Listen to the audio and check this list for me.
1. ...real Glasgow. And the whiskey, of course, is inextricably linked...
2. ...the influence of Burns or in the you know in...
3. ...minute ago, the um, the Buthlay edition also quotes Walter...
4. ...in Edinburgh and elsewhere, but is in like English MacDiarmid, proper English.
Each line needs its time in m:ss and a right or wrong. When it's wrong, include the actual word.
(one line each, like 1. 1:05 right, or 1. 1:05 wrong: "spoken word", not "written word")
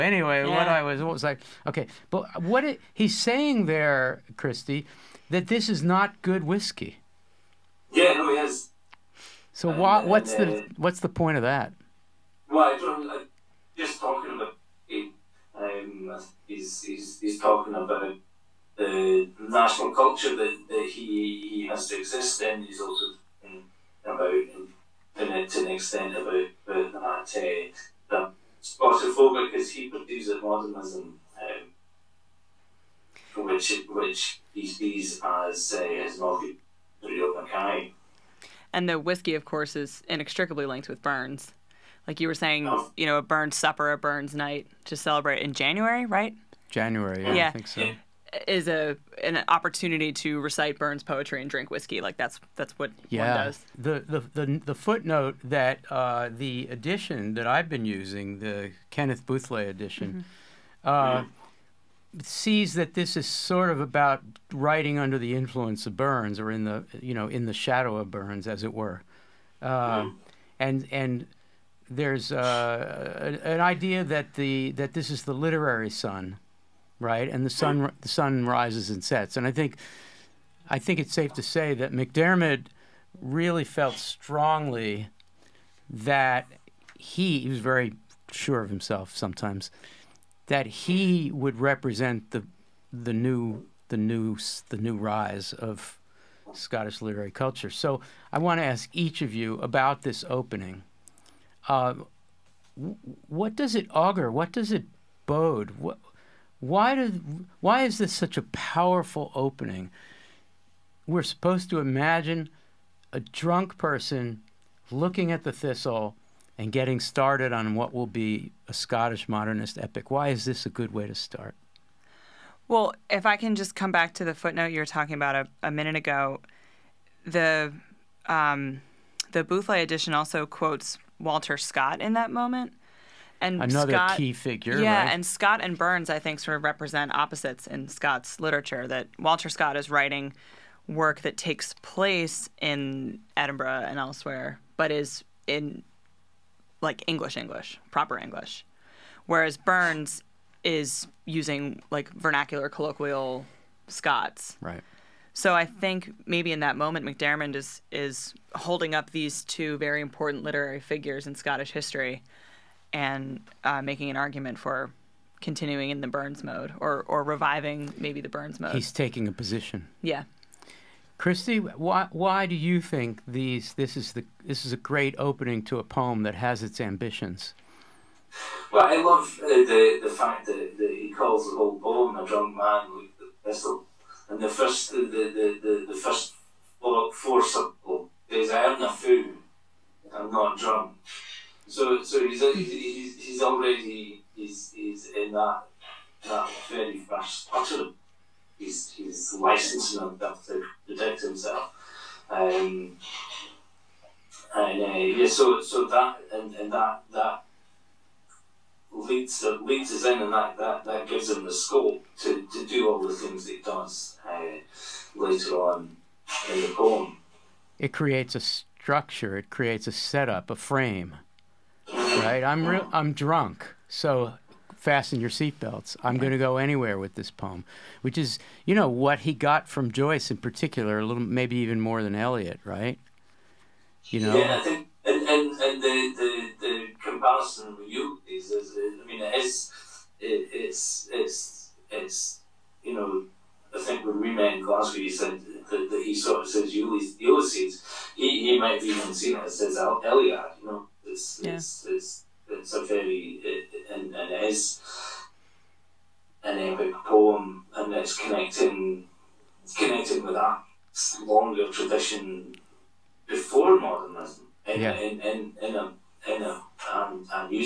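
1. 0:37 wrong: "Mackay", not "Glasgow"
2. 1:05 right
3. 2:05 right
4. 2:22 wrong: "English", not "MacDiarmid".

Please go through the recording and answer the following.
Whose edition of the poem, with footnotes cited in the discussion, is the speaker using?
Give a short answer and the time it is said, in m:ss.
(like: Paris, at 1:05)
Kenneth Buthlay, at 0:58.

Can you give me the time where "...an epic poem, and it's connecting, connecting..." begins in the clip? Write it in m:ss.
4:16.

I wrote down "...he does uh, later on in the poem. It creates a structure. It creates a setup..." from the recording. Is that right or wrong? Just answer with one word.
right.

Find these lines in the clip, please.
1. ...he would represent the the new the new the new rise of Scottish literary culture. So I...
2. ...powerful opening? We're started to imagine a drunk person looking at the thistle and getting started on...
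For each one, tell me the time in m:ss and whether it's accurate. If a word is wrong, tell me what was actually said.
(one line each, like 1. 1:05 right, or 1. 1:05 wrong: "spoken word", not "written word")
1. 1:30 right
2. 1:48 wrong: "supposed", not "started".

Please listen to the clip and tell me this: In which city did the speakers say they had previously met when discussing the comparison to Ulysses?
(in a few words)
Glasgow.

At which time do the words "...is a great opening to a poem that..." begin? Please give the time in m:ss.
2:54.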